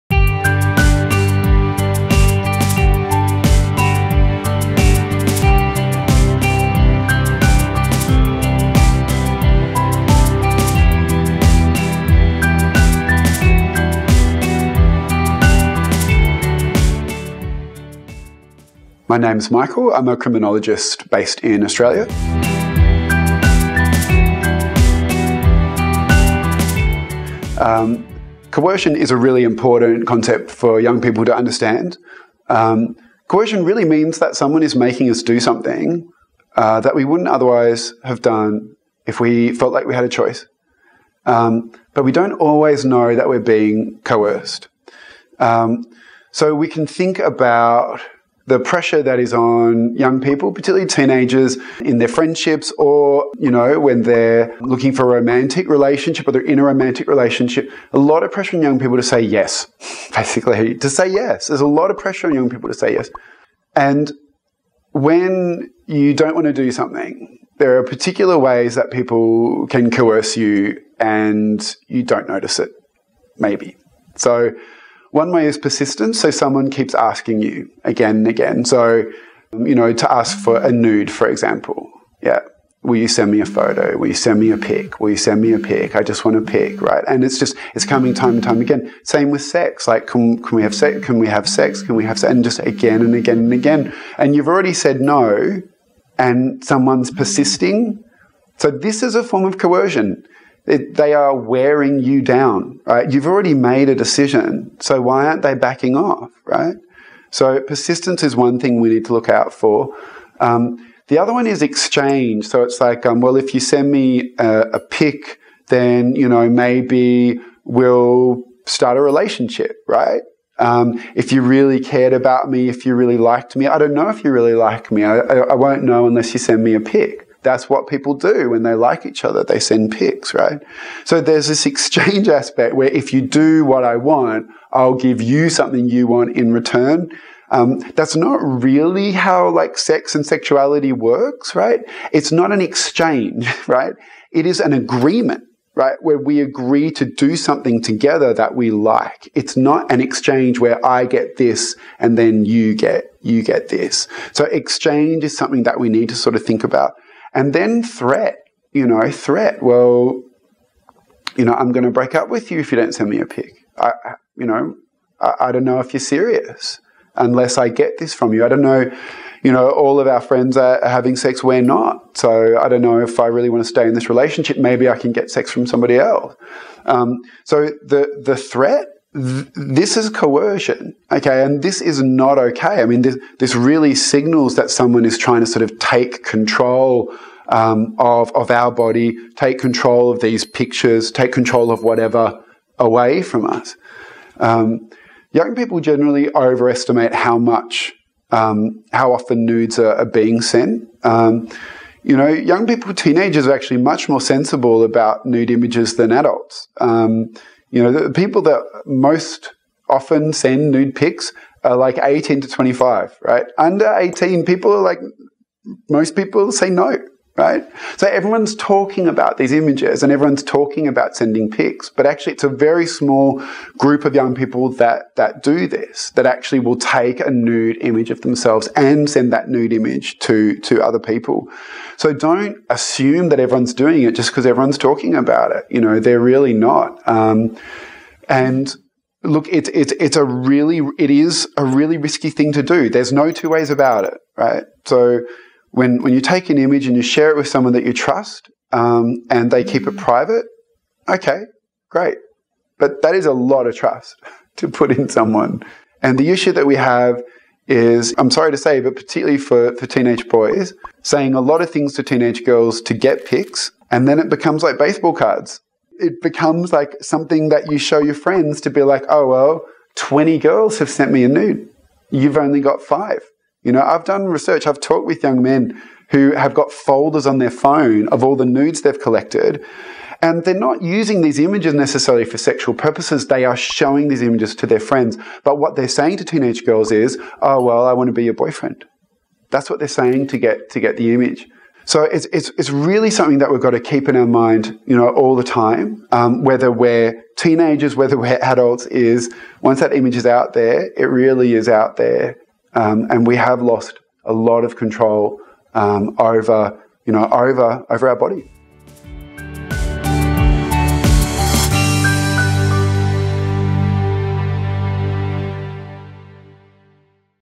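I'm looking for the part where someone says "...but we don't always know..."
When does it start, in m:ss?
0:41.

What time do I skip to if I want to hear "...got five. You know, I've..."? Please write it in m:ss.
4:32.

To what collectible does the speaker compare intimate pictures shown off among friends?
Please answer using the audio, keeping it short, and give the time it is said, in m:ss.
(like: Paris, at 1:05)
baseball cards, at 4:24.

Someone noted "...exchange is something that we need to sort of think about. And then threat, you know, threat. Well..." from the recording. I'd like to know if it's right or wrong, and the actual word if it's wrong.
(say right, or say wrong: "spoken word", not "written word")
right.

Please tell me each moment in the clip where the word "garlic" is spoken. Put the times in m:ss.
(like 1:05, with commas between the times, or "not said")
not said.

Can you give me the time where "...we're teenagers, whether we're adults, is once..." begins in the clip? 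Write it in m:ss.
4:56.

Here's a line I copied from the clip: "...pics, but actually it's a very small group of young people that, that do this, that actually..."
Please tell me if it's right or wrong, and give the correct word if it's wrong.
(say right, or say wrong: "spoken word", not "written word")
right.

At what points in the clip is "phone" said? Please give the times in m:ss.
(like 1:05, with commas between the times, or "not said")
4:37.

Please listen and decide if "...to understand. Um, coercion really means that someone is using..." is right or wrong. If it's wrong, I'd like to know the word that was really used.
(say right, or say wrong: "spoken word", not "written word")
wrong: "making", not "using".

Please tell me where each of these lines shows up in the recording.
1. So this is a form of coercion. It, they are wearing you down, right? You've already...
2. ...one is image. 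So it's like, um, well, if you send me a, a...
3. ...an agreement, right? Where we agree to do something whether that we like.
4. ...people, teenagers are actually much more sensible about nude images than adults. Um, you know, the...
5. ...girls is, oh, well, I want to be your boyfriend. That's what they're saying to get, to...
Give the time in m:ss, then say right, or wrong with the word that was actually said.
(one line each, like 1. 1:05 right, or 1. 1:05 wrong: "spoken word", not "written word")
1. 1:38 right
2. 1:51 wrong: "exchange", not "image"
3. 2:24 wrong: "together", not "whether"
4. 3:22 right
5. 4:46 right.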